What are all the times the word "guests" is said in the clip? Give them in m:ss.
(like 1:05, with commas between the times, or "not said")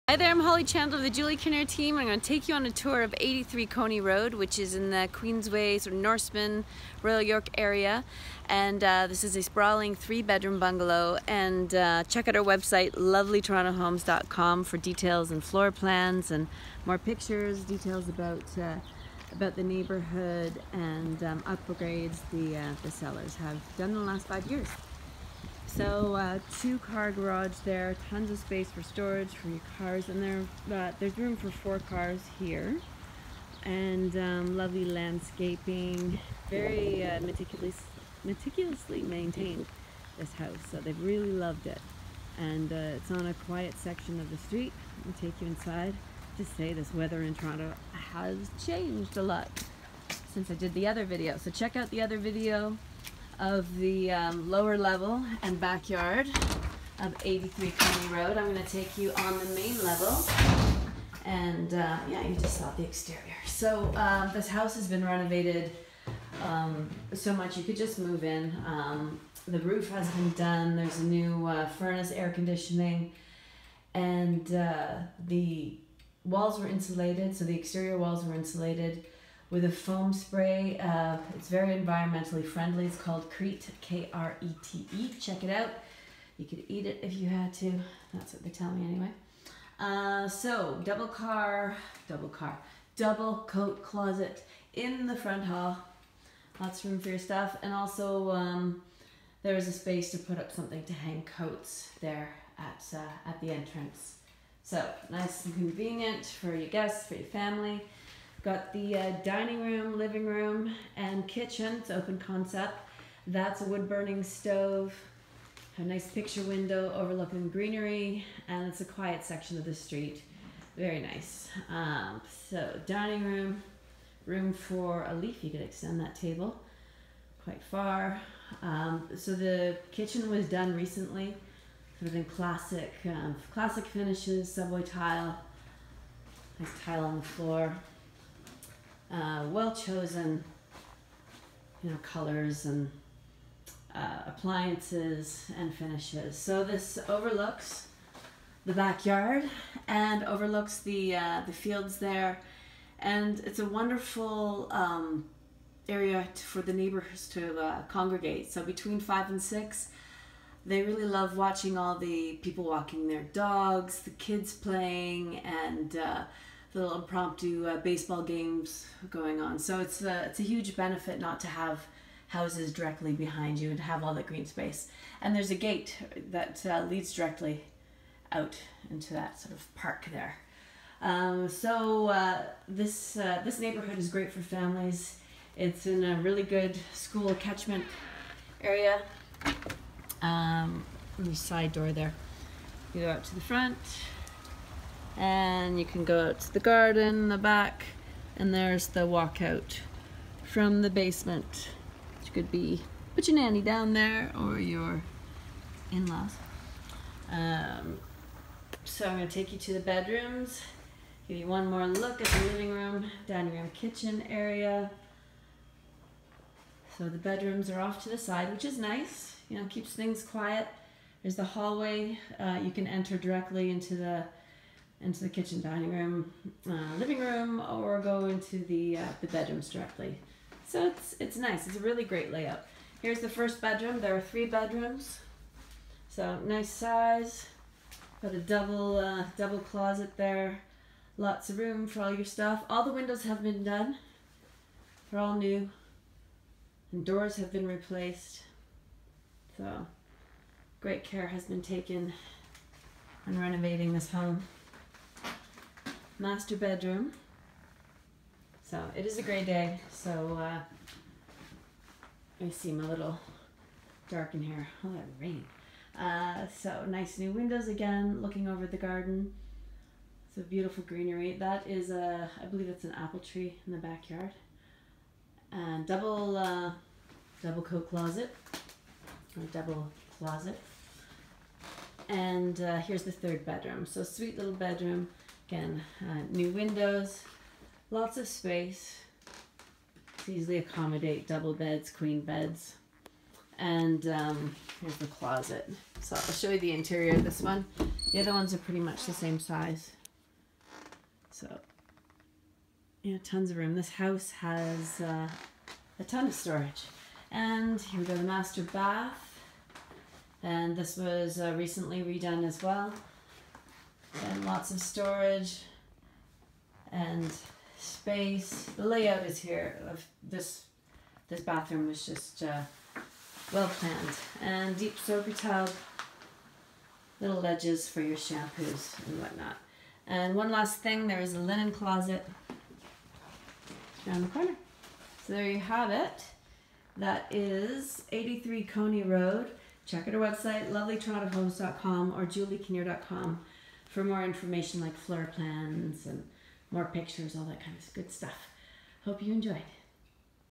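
1:46.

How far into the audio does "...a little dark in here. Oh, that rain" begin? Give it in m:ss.
4:22.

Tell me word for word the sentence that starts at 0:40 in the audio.
So they've really loved it, and uh, it's on a quiet section of the street.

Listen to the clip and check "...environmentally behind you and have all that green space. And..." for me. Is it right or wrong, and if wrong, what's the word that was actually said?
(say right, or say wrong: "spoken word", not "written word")
wrong: "directly", not "environmentally".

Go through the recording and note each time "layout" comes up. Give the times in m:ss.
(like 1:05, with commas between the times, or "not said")
3:52, 5:18.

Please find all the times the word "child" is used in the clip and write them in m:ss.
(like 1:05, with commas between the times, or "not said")
not said.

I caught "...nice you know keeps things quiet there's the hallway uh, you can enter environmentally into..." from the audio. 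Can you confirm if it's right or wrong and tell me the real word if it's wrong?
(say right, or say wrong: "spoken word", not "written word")
wrong: "directly", not "environmentally".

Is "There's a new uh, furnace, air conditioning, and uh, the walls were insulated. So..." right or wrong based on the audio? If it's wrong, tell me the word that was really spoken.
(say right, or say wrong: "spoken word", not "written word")
right.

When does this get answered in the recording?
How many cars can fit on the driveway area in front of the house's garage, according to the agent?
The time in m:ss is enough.
0:31.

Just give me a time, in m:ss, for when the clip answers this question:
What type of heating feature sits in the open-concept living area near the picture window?
1:53.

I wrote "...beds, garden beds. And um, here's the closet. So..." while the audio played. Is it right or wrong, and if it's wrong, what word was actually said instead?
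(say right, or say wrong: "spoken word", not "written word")
wrong: "queen", not "garden".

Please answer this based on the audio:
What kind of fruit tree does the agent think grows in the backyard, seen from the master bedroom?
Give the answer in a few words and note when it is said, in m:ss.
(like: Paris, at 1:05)
Apple tree, at 4:32.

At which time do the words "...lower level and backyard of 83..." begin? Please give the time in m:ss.
0:54.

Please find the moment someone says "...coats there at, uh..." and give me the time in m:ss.
1:41.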